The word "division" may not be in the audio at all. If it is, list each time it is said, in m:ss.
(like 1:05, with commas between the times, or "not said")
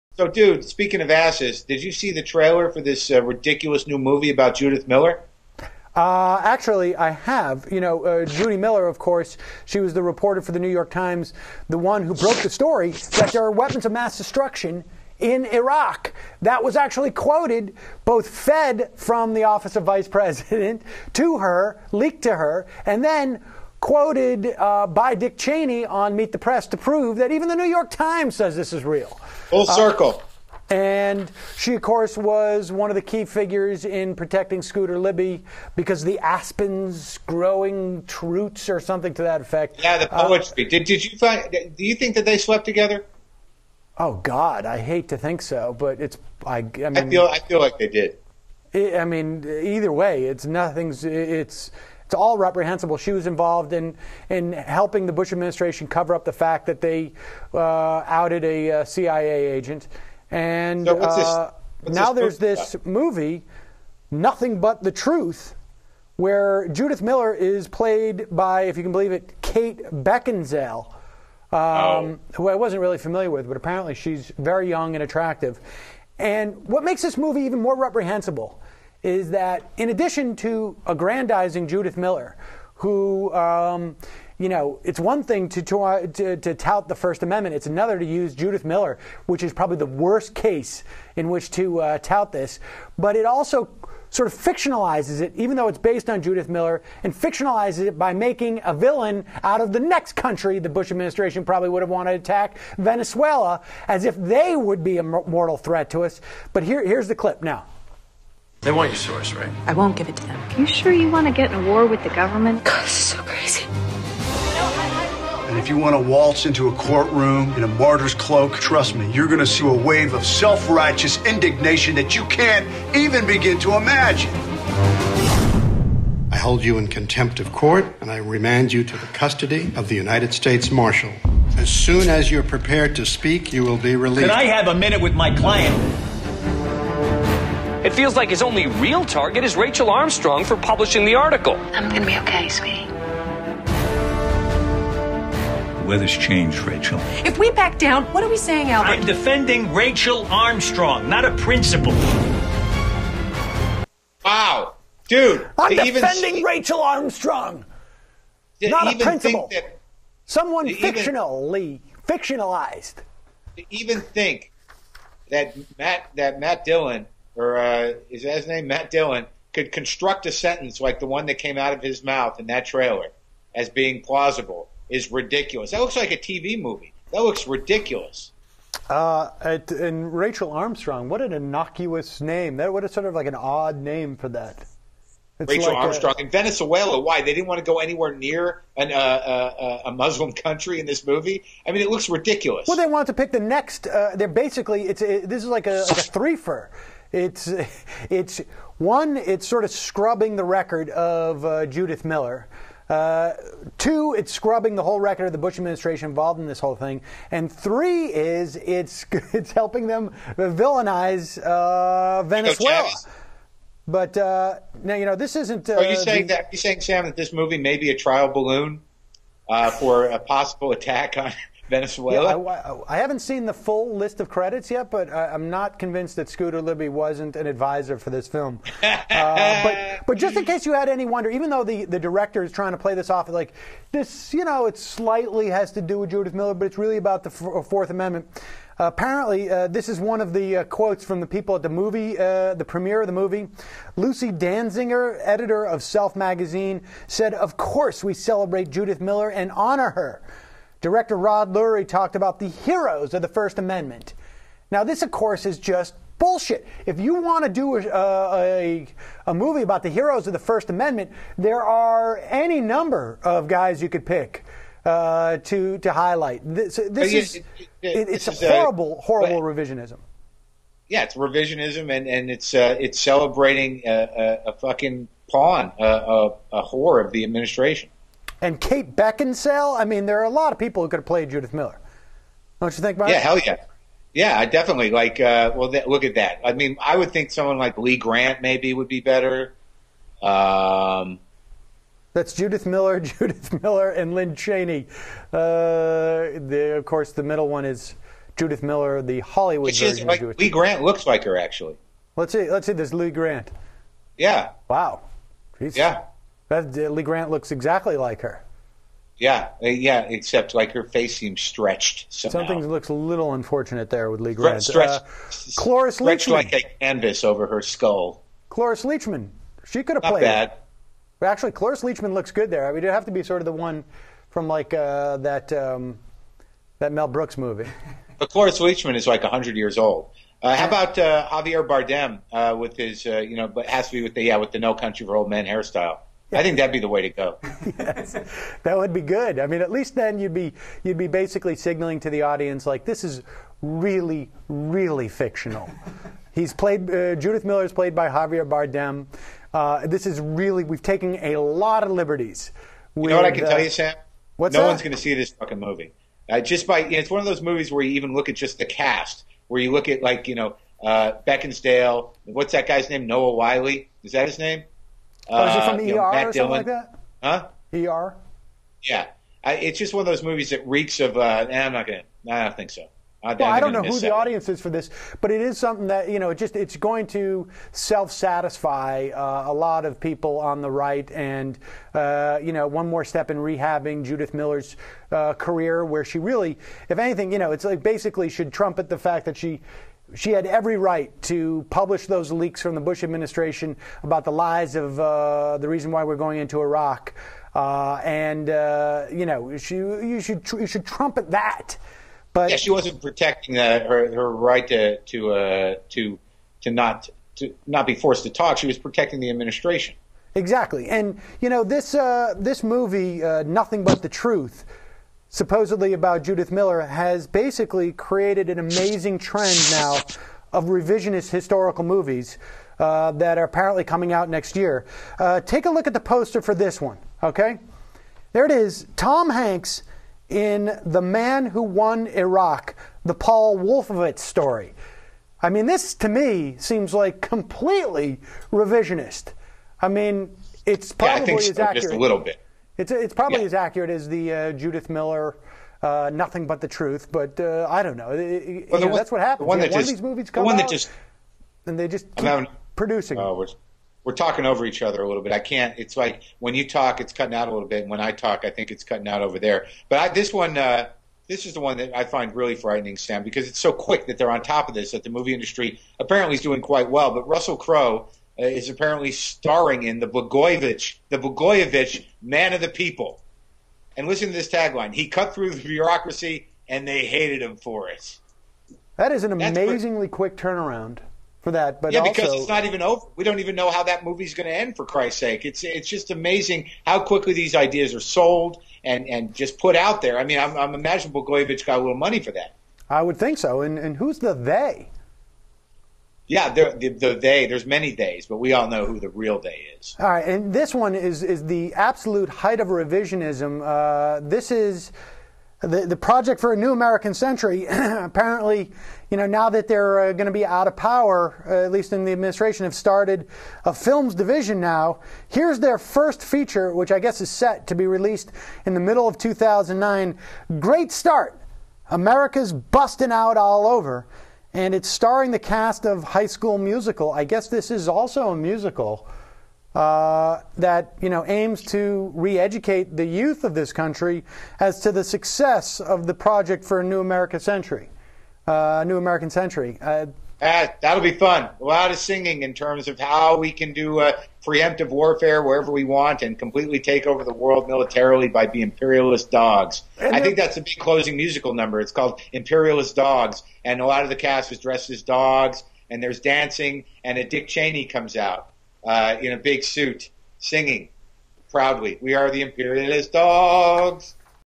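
8:34.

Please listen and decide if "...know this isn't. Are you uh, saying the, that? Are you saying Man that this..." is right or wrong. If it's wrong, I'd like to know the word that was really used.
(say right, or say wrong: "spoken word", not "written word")
wrong: "Sam", not "Man".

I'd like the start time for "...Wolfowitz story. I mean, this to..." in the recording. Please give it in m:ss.
7:13.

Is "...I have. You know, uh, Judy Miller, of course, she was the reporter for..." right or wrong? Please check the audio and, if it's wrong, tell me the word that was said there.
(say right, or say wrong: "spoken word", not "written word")
right.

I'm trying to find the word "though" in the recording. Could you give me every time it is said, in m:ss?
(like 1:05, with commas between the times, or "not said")
1:35, 3:51.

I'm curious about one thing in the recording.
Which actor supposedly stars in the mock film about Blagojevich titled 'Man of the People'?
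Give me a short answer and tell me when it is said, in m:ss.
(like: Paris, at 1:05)
Russell Crowe, at 7:47.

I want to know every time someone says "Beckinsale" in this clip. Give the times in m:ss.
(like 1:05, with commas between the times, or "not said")
1:09, 4:38, 6:01.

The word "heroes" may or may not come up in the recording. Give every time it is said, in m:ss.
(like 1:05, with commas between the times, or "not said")
4:12, 4:19.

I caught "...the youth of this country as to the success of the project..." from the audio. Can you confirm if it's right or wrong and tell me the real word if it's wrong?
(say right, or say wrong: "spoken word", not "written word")
right.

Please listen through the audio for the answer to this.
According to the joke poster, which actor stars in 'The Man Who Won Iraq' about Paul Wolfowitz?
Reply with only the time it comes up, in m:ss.
7:08.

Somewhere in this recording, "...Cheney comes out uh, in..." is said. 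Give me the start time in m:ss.
9:17.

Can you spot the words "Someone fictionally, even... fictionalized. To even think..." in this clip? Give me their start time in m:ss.
2:40.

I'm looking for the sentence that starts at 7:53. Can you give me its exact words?
And listen to this tagline: He cut through the bureaucracy, and they hated him for it.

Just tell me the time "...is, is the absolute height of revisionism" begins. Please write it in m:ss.
8:20.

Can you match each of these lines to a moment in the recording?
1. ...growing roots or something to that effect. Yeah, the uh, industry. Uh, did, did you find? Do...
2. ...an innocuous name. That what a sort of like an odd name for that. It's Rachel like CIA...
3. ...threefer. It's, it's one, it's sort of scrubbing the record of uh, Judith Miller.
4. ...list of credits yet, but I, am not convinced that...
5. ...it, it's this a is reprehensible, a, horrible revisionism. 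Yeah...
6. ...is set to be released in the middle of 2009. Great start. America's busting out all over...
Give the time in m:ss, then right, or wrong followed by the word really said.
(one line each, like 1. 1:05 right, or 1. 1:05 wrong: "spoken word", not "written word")
1. 0:37 wrong: "poetry", not "industry"
2. 3:01 wrong: "Armstrong", not "CIA"
3. 3:15 right
4. 3:43 right
5. 4:27 wrong: "horrible", not "reprehensible"
6. 8:37 right.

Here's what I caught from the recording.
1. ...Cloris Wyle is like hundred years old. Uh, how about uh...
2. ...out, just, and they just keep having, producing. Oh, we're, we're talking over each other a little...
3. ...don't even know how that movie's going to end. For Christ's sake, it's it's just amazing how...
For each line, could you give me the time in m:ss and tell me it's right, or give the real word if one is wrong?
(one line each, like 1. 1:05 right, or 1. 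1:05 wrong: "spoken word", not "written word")
1. 5:28 wrong: "Leachman", not "Wyle"
2. 7:30 right
3. 8:03 right.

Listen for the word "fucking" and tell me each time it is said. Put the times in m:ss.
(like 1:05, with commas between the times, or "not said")
4:34, 5:55.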